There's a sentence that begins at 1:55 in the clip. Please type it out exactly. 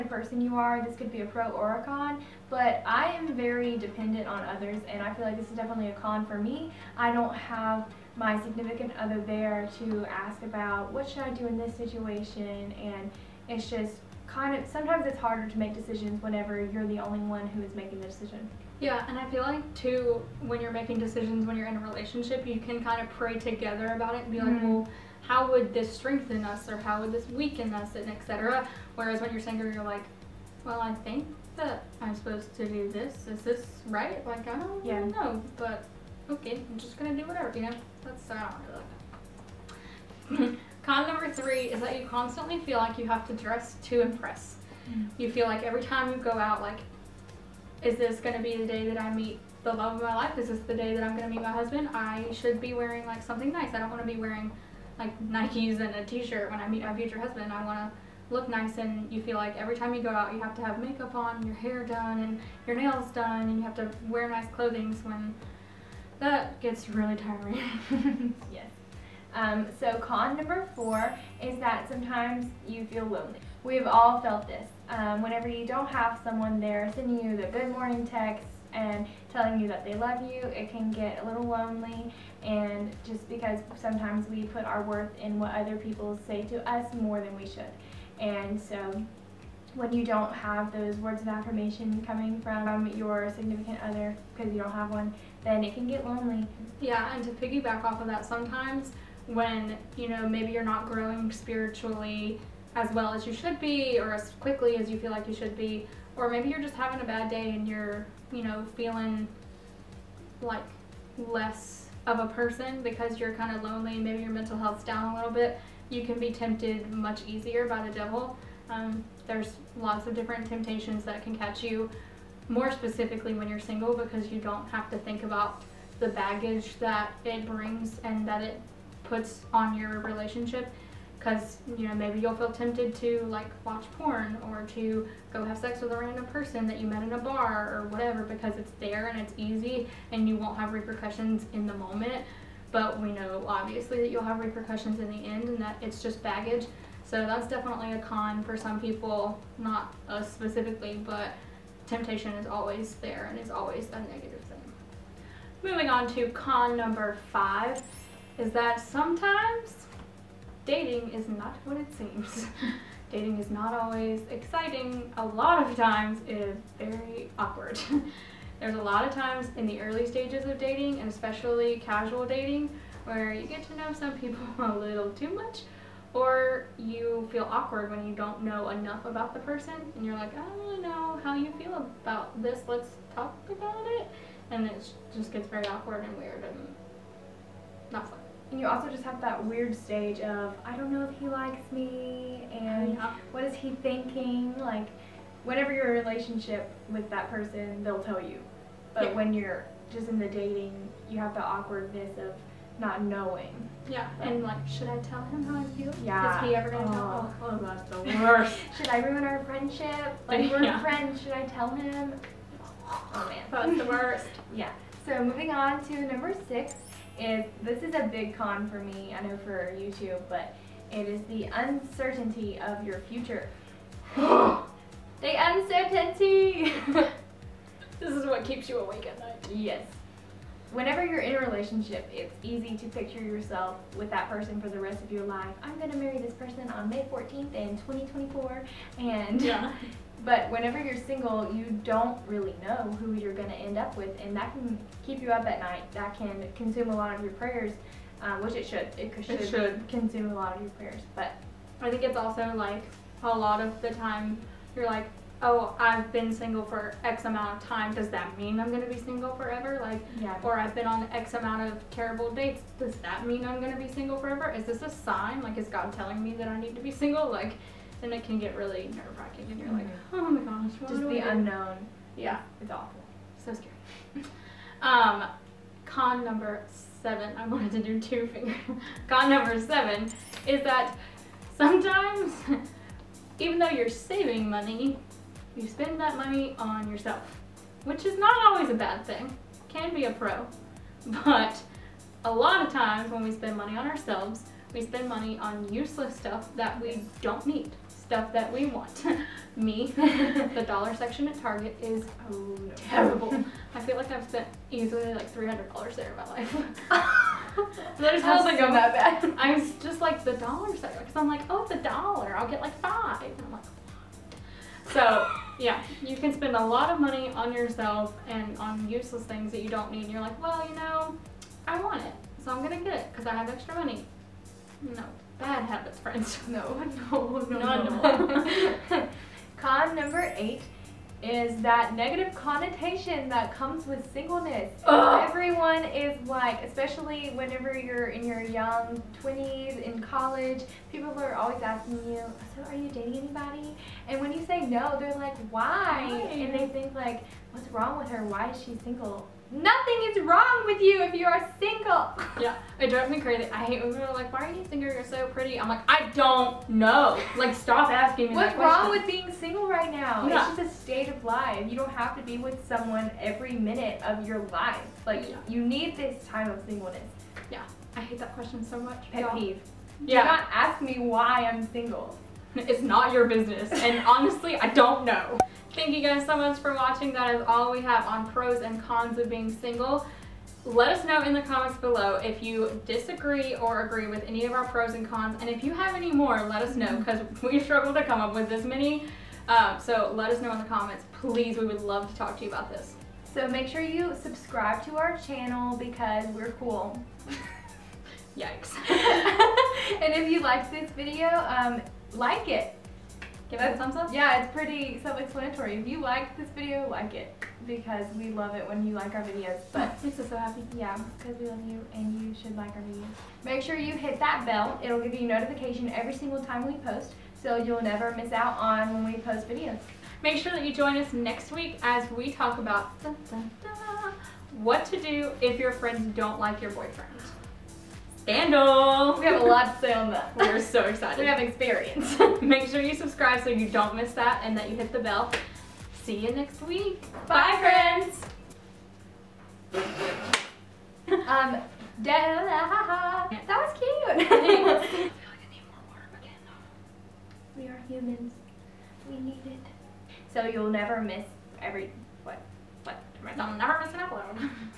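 You can be tempted much easier by the devil.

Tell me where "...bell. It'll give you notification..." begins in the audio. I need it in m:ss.
6:54.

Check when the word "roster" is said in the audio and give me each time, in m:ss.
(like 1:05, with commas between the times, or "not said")
not said.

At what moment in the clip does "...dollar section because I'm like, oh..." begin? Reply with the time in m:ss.
5:10.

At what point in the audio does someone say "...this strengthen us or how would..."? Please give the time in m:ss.
0:25.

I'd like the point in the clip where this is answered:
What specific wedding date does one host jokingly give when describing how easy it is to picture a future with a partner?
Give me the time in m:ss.
3:56.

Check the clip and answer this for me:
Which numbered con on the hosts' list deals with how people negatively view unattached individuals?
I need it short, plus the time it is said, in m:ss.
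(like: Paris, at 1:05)
8, at 5:30.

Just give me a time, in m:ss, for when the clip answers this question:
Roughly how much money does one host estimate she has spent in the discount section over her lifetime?
5:05.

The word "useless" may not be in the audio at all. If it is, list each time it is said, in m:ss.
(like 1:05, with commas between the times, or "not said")
4:55, 5:18.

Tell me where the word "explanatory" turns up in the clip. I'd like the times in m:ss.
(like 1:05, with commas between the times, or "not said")
6:45.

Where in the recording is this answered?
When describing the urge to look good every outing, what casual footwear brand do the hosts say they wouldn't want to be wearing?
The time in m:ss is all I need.
0:55.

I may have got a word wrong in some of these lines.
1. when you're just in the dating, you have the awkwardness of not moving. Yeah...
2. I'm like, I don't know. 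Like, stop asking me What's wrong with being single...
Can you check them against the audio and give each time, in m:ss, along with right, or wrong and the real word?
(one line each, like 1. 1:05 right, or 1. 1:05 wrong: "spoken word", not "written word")
1. 3:19 wrong: "knowing", not "moving"
2. 5:55 right.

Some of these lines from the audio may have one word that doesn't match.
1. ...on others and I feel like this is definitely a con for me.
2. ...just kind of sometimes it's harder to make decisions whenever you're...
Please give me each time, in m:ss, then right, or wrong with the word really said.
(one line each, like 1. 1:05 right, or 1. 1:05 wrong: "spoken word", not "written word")
1. 0:04 right
2. 0:13 right.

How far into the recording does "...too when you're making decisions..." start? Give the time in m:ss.
0:19.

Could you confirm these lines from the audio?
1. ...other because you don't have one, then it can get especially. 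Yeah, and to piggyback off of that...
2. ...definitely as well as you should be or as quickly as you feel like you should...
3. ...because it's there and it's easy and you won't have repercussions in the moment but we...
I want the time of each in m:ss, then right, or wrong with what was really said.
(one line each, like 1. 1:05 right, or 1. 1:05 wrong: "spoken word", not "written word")
1. 1:33 wrong: "lonely", not "especially"
2. 1:41 wrong: "spiritually", not "definitely"
3. 2:18 right.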